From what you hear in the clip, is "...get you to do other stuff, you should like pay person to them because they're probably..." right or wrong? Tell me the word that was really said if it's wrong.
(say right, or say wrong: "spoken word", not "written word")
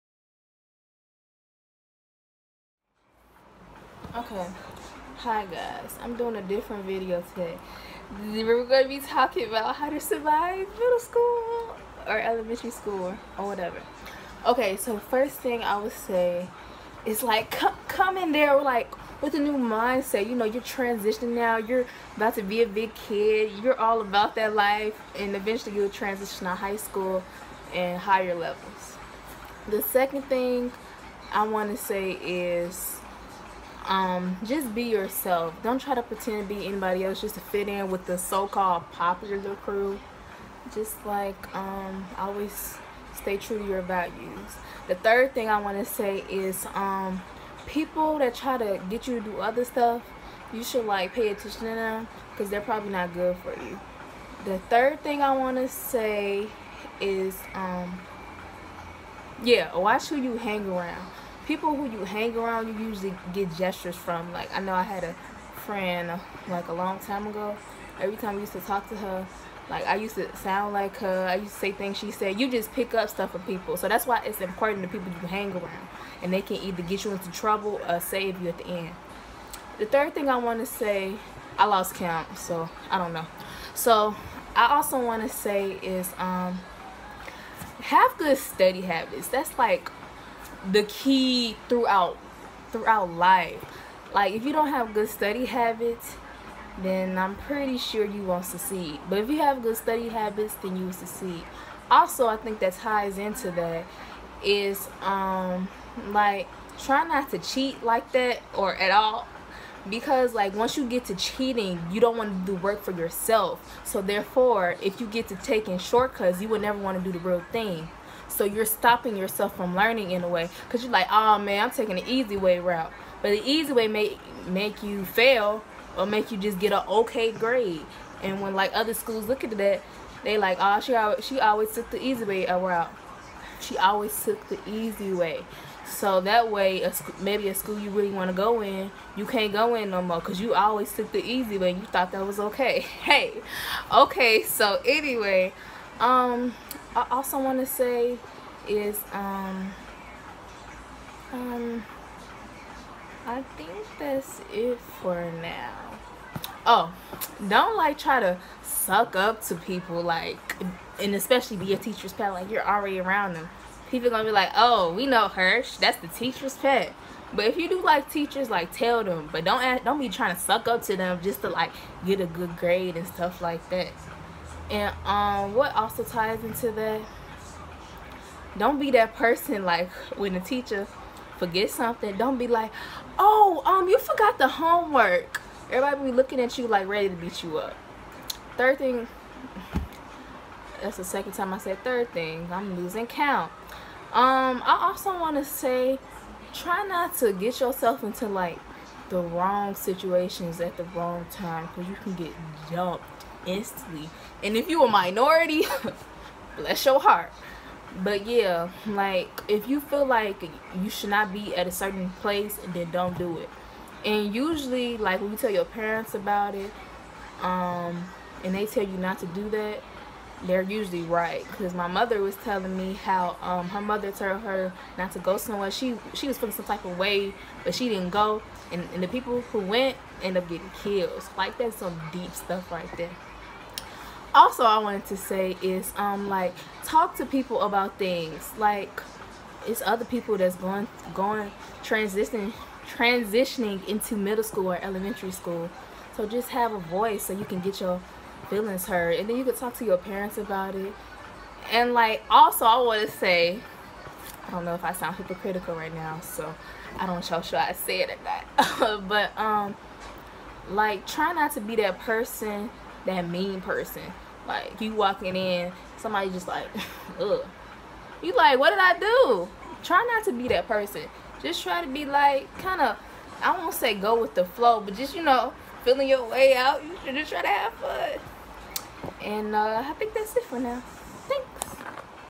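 wrong: "attention", not "person".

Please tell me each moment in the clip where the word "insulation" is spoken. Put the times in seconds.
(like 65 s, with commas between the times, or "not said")
not said.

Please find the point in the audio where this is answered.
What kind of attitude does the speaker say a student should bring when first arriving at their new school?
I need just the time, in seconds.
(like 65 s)
19 s.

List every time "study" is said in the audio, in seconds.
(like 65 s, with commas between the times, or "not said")
88 s, 95 s, 99 s.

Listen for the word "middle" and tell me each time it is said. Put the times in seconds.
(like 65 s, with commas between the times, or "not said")
10 s, 244 s.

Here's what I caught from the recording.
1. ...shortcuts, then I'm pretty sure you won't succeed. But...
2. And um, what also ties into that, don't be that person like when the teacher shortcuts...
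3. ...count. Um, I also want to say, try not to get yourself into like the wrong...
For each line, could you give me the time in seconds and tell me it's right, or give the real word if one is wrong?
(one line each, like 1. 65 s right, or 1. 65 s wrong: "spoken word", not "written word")
1. 95 s wrong: "habits", not "shortcuts"
2. 174 s wrong: "forgets", not "shortcuts"
3. 193 s right.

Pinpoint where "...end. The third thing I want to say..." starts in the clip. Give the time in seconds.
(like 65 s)
78 s.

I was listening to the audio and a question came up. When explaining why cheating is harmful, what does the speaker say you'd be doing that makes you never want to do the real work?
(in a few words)
taking shortcuts.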